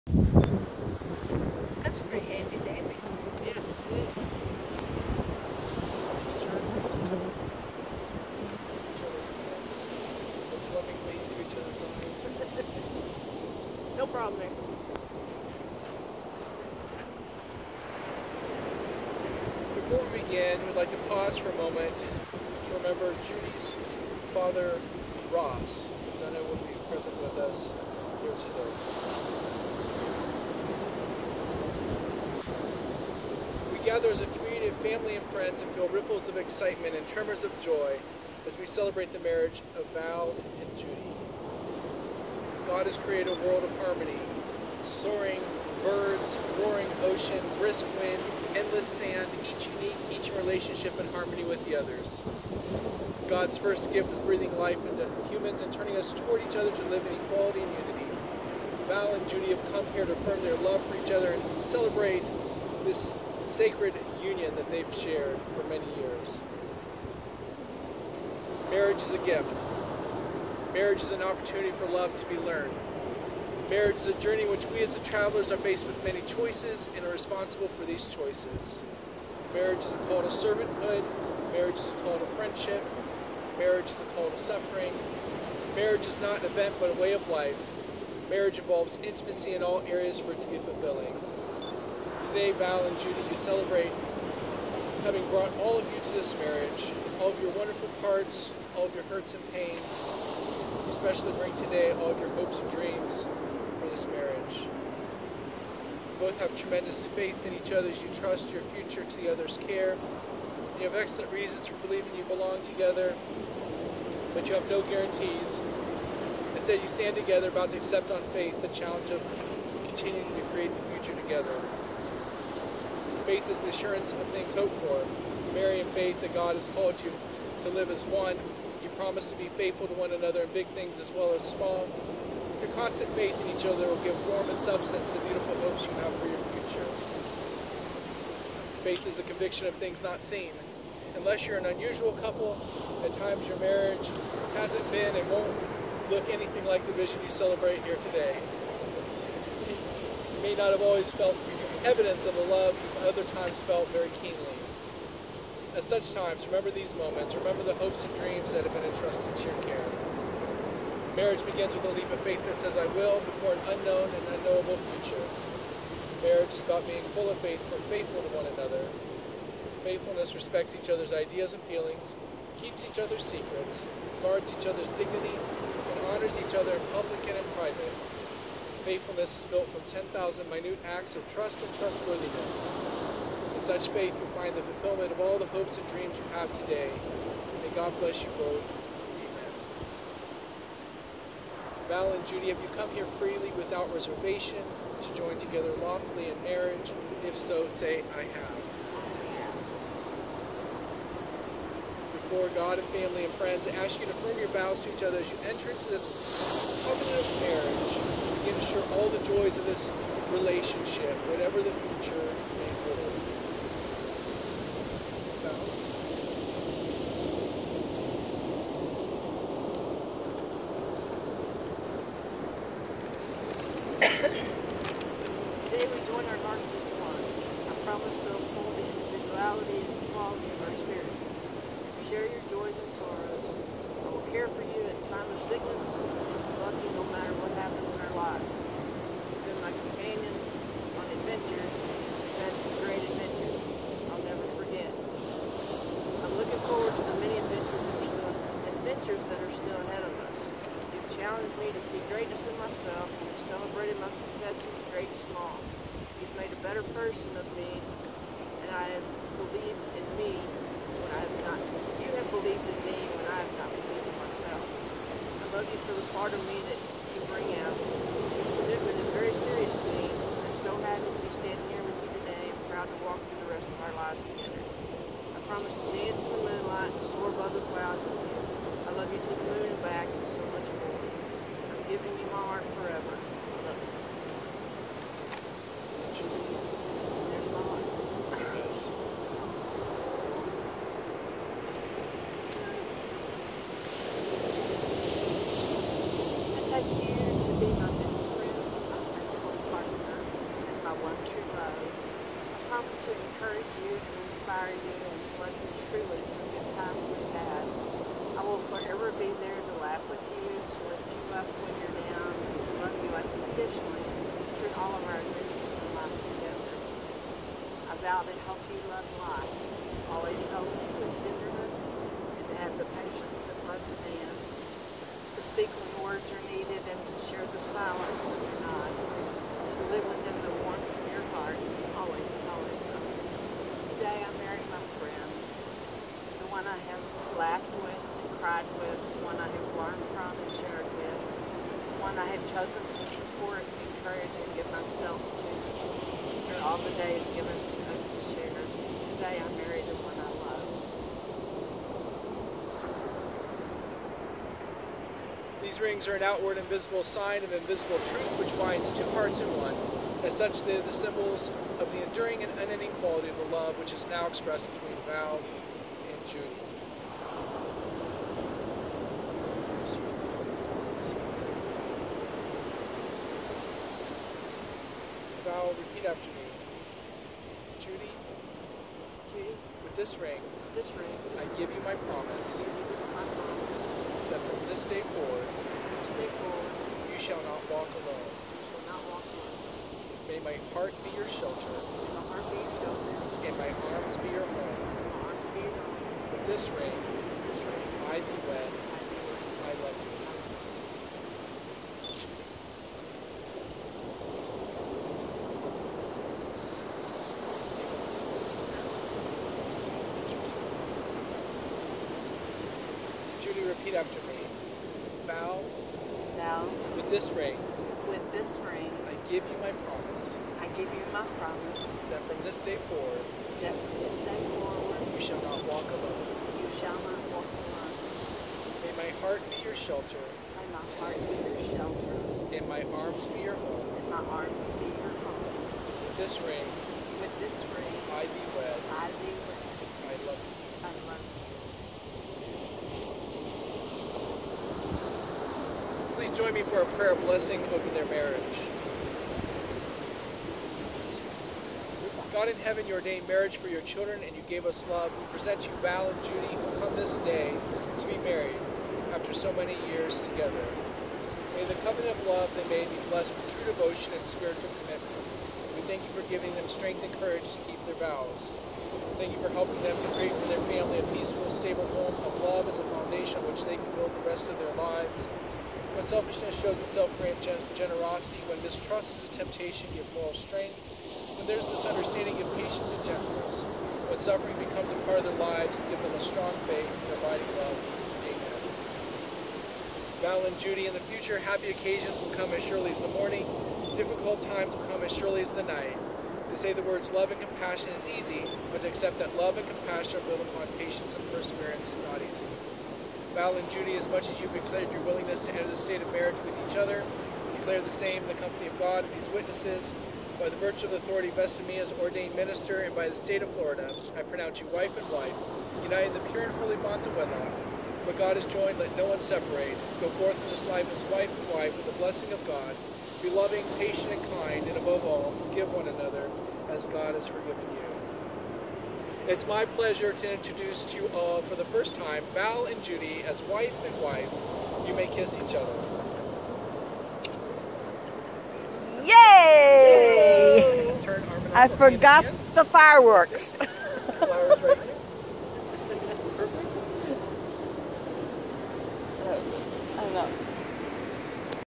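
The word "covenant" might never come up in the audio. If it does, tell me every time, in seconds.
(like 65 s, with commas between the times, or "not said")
206 s, 461 s.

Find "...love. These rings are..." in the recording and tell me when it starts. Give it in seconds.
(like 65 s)
355 s.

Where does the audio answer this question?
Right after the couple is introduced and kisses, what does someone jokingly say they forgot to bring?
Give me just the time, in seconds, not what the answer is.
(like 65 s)
542 s.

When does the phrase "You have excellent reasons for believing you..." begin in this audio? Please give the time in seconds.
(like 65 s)
110 s.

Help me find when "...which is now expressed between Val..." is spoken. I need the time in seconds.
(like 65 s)
363 s.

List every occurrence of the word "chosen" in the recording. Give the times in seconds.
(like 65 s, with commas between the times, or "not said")
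342 s.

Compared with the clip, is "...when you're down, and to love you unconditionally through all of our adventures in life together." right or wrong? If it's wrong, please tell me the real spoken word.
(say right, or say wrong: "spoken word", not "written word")
right.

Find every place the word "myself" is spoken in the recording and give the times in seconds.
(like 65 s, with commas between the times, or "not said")
252 s, 264 s, 344 s.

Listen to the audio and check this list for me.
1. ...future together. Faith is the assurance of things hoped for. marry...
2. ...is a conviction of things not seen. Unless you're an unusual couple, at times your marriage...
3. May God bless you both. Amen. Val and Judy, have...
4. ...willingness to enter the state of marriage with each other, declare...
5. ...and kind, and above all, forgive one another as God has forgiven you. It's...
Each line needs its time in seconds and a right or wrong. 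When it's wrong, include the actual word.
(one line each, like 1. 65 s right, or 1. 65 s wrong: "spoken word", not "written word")
1. 120 s right
2. 139 s right
3. 187 s right
4. 505 s right
5. 524 s right.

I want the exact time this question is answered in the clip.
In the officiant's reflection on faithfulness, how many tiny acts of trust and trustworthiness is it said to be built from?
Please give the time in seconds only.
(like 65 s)
179 s.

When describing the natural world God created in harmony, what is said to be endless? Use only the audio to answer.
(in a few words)
Sand.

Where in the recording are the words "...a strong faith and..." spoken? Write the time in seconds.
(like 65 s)
486 s.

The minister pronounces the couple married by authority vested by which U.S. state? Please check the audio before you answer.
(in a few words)
Florida.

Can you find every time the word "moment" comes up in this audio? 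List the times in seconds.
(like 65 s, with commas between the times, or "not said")
21 s, 156 s.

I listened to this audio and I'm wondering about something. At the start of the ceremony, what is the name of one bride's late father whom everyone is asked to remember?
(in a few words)
Ross.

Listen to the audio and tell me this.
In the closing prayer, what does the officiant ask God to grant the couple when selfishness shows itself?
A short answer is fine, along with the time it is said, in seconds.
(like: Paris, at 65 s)
Generosity, at 477 s.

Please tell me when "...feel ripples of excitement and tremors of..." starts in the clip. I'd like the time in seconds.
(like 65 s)
35 s.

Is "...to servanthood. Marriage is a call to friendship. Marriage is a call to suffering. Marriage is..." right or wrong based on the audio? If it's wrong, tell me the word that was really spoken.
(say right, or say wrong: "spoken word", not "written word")
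right.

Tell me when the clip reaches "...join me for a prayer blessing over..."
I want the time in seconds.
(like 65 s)
446 s.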